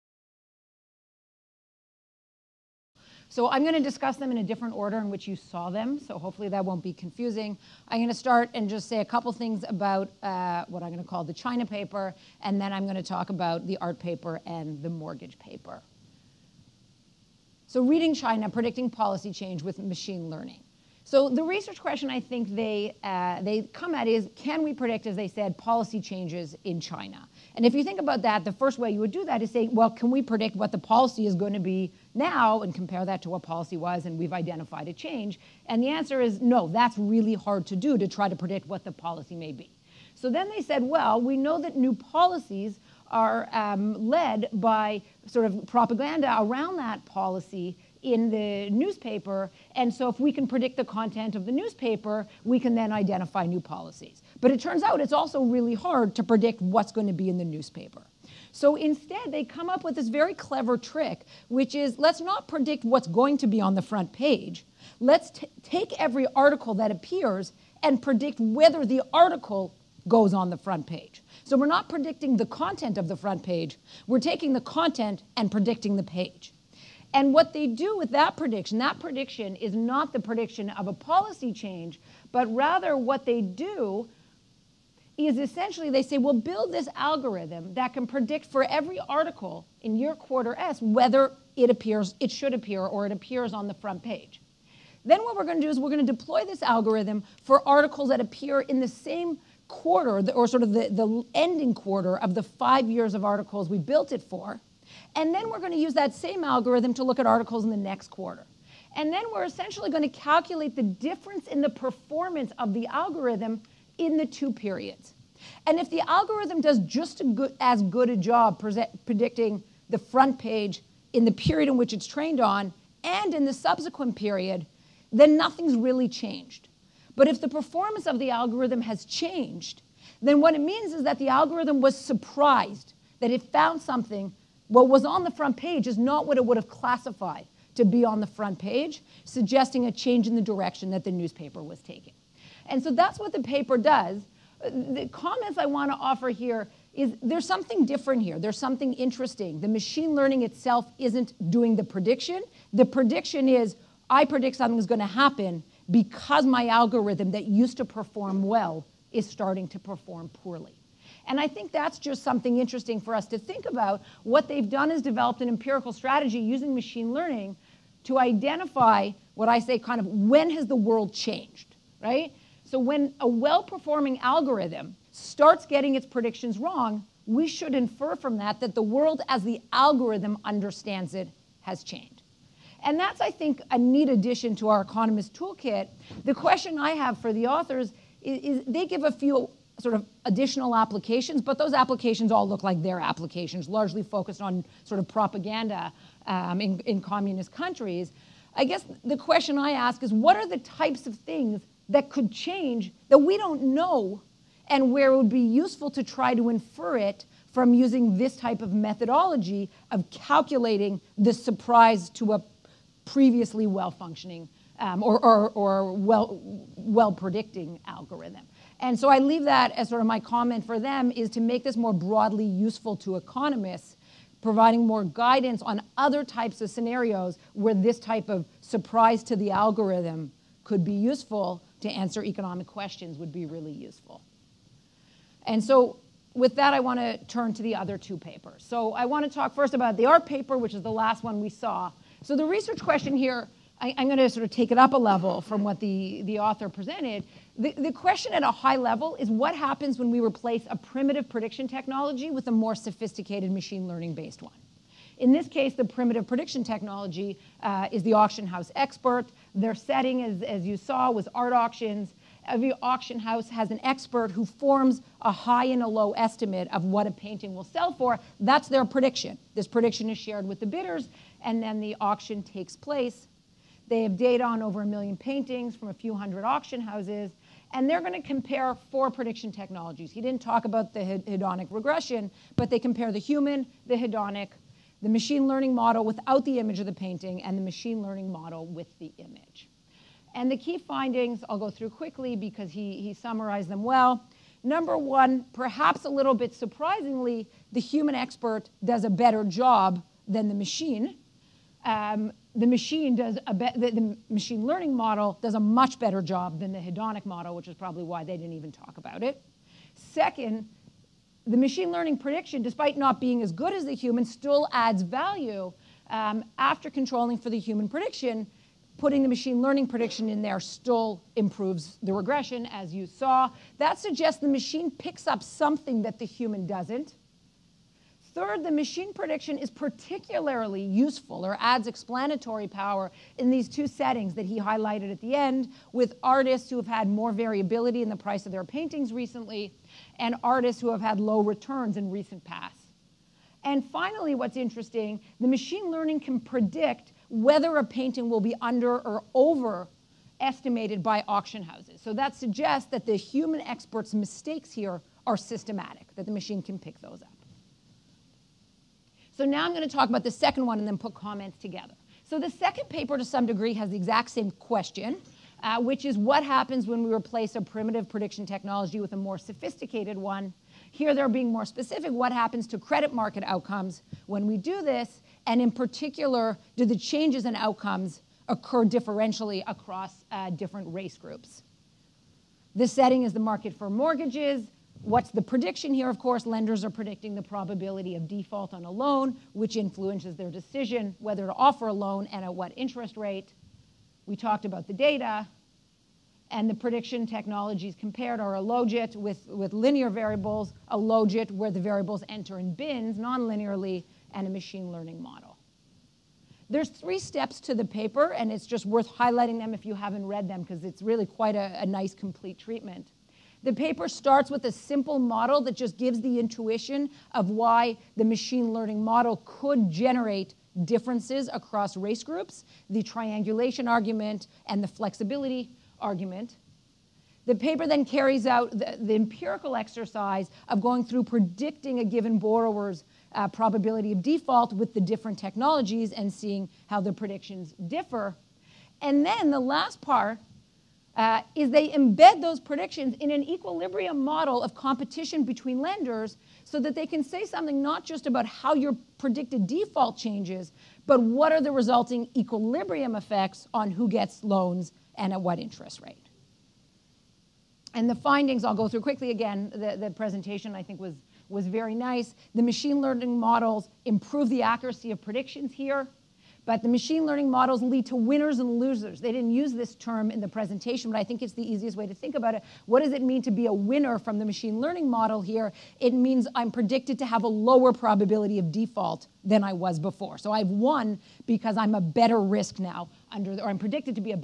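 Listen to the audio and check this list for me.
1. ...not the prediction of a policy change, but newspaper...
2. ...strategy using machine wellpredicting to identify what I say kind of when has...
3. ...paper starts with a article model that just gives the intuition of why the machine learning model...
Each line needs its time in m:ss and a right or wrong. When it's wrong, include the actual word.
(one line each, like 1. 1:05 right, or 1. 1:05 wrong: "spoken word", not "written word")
1. 1:19 wrong: "rather", not "newspaper"
2. 2:45 wrong: "learning", not "wellpredicting"
3. 6:53 wrong: "simple", not "article".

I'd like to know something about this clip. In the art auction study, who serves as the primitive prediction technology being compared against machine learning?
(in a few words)
The auction house expert.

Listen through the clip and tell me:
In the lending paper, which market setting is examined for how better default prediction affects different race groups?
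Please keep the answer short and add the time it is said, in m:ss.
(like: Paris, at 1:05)
The market for mortgages, at 6:23.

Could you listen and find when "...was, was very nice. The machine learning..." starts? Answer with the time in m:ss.
7:40.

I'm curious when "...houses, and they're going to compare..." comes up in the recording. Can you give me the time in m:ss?
4:36.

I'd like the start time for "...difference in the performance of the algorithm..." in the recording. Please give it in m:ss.
1:50.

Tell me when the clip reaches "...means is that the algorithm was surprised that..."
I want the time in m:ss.
2:10.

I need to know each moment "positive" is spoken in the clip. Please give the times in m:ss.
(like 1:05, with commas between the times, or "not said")
not said.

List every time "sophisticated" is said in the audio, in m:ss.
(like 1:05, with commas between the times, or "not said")
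4:12, 6:09.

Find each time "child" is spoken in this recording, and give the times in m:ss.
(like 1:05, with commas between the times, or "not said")
not said.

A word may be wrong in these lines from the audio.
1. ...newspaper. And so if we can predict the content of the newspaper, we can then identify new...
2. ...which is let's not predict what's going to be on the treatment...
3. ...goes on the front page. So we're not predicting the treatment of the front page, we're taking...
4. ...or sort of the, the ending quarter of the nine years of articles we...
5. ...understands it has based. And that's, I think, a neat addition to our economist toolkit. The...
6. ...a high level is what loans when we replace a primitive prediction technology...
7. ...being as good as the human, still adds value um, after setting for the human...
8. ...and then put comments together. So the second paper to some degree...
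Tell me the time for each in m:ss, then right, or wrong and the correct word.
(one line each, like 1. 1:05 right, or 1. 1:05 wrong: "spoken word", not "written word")
1. 0:48 right
2. 1:01 wrong: "front", not "treatment"
3. 1:10 wrong: "content", not "treatment"
4. 1:40 wrong: "five", not "nine"
5. 3:00 wrong: "changed", not "based"
6. 4:08 wrong: "happens", not "loans"
7. 5:13 wrong: "controlling", not "setting"
8. 6:00 right.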